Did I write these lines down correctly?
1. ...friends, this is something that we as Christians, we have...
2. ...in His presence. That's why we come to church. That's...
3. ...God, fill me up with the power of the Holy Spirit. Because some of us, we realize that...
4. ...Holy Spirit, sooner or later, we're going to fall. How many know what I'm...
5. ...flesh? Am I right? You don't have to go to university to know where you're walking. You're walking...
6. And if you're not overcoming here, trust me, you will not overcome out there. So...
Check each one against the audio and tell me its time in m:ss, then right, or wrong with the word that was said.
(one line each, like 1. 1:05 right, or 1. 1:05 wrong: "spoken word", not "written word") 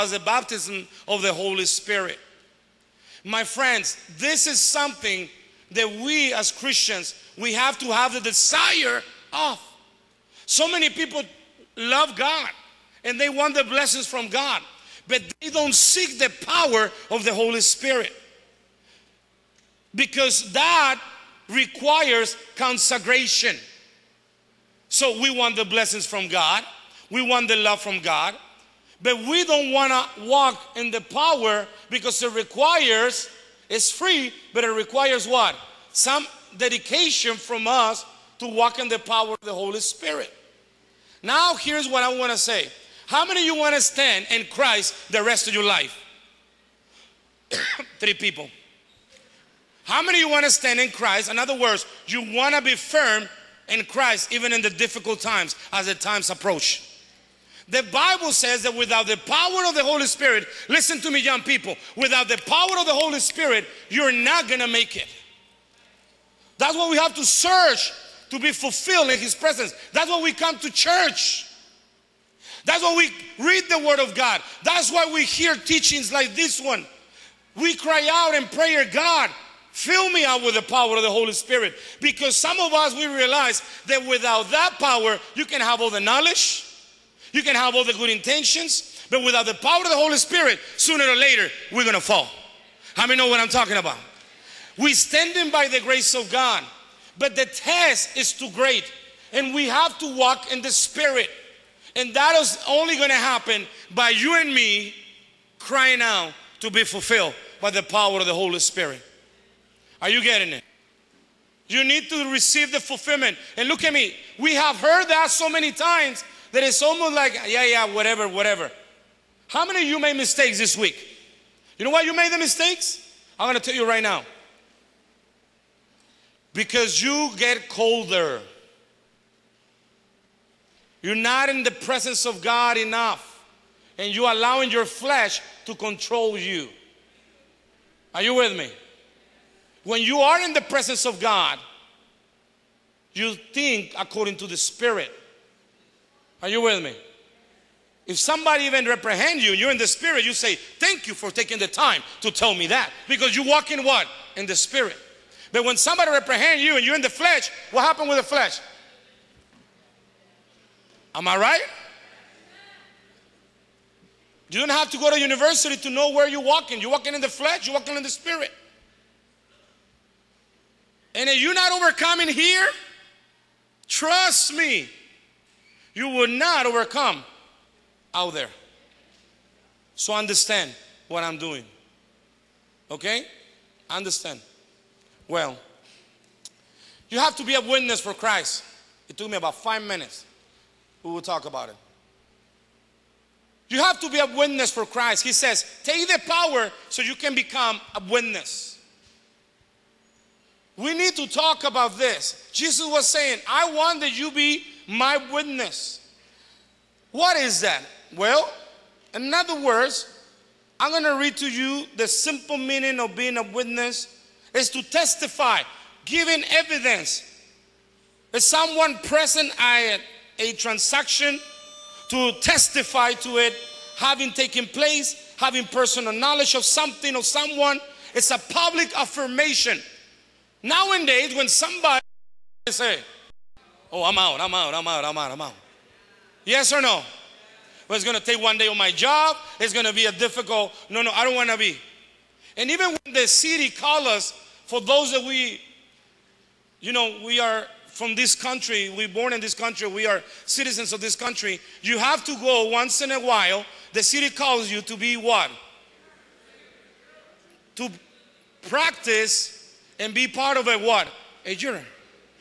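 1. 0:03 right
2. 1:09 right
3. 1:18 right
4. 1:29 right
5. 2:38 right
6. 2:51 right.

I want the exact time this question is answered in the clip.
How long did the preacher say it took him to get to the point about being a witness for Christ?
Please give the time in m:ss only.
3:09.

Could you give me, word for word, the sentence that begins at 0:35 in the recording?
Some dedication from us to walk in the power of the Holy Spirit.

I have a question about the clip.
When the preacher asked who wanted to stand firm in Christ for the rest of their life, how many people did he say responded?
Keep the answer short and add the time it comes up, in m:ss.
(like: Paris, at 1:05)
3, at 0:47.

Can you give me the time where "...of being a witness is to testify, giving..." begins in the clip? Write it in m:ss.
3:32.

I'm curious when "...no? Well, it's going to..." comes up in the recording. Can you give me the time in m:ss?
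3:56.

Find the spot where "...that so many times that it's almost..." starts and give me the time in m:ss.
1:55.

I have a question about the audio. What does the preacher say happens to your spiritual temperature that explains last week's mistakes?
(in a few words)
You get colder.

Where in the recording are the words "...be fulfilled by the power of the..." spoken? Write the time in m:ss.
1:46.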